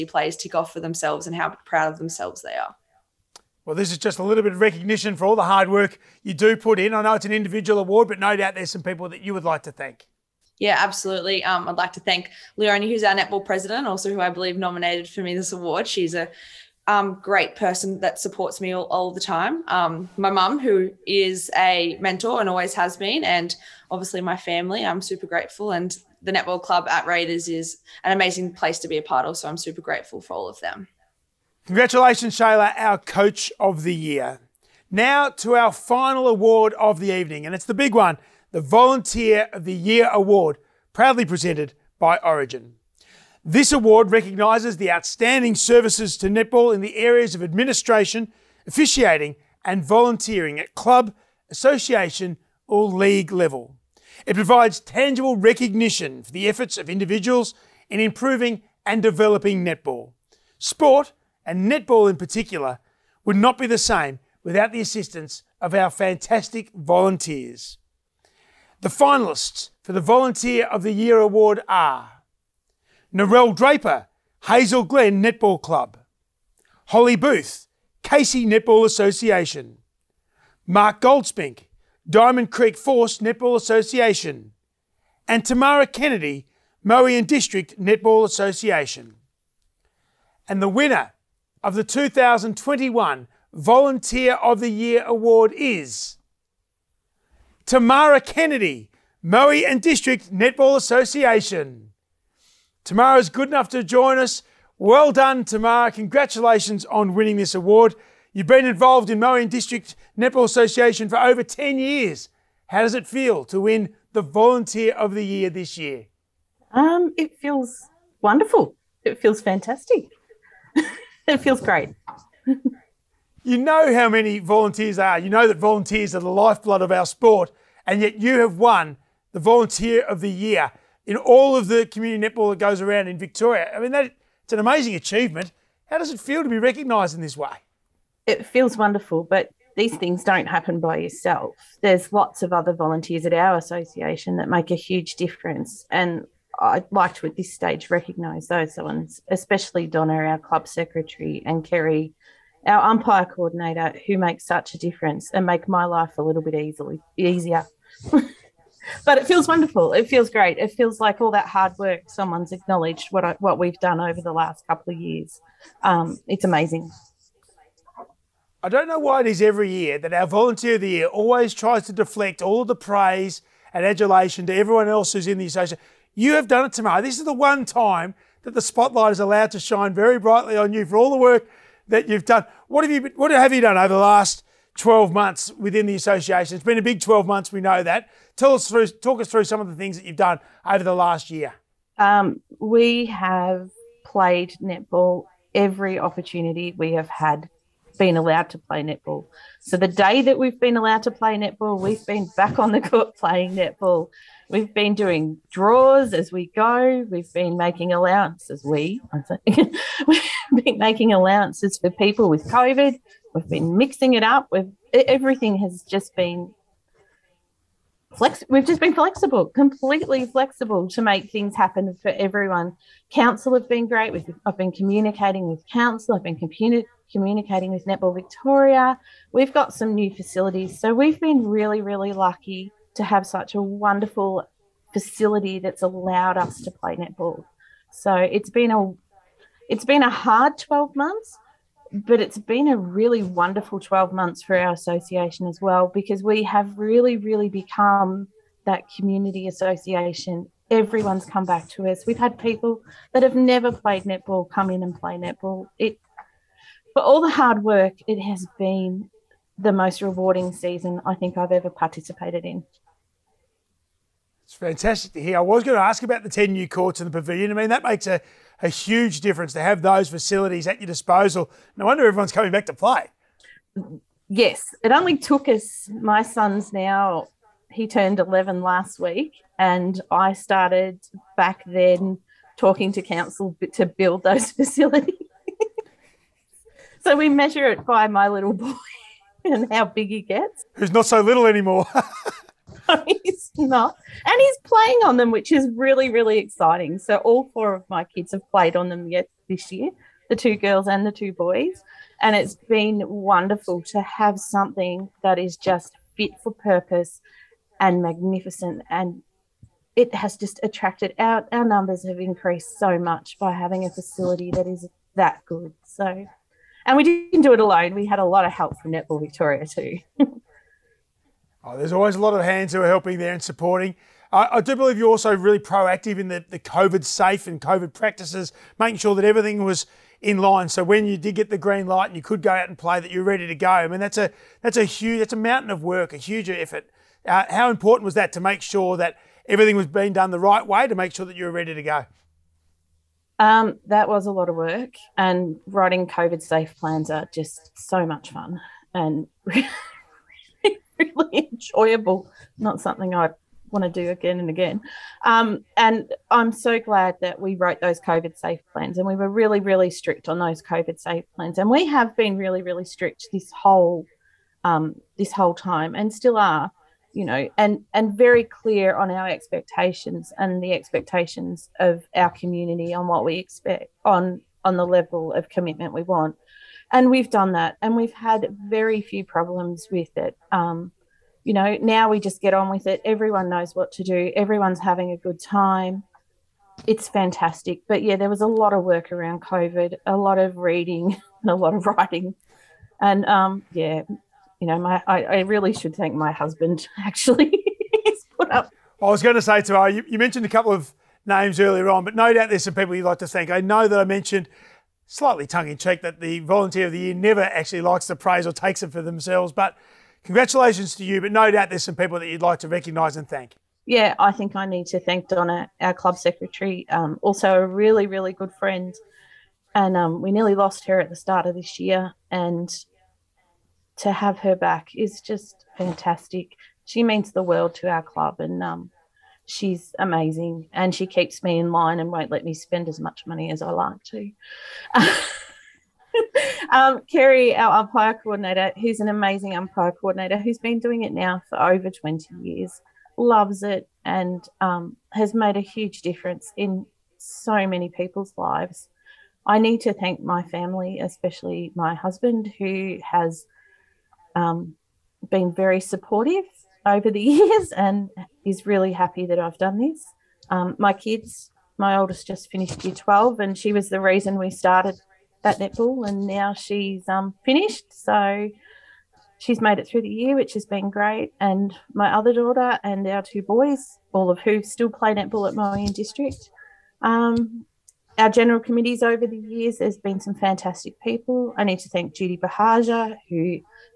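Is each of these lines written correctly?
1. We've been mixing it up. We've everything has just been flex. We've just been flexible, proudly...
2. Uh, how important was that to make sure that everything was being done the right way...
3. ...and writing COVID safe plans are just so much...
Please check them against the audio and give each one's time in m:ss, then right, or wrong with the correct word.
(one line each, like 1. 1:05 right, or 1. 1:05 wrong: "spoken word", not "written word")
1. 3:33 wrong: "completely", not "proudly"
2. 5:37 right
3. 5:45 right.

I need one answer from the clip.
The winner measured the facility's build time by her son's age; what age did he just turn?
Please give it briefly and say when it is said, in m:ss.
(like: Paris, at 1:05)
11, at 4:38.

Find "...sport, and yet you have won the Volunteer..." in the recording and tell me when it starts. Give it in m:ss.
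2:07.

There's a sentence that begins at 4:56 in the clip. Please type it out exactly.
So all four of my kids have played on them yet this year, the two girls and the two boys.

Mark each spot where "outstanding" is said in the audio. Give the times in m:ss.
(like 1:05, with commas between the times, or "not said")
0:44.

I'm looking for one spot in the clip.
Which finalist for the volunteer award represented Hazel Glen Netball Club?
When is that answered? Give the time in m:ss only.
1:13.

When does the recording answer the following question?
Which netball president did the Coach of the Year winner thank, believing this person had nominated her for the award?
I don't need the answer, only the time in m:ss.
0:12.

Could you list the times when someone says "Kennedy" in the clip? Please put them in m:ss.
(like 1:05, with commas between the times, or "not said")
1:25, 1:38.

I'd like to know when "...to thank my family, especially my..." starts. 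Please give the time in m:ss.
7:29.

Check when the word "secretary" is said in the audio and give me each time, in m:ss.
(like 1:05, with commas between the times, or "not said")
2:30, 6:56.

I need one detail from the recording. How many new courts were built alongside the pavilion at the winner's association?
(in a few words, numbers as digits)
10.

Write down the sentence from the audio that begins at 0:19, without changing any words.
Um, my mum, who is a mentor and always has been, and obviously my family.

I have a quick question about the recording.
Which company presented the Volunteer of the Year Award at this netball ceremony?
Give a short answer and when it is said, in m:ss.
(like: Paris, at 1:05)
Origin, at 0:42.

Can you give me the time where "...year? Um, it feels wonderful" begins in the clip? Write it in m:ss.
1:55.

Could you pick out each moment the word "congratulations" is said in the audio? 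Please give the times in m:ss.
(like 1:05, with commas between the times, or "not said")
0:31, 1:45, 6:50.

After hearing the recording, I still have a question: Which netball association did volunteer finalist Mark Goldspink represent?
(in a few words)
Diamond Creek Force Netball Association.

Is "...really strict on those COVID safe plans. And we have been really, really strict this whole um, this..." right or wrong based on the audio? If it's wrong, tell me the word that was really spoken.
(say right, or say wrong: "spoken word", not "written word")
right.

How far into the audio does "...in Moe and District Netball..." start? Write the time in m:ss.
1:49.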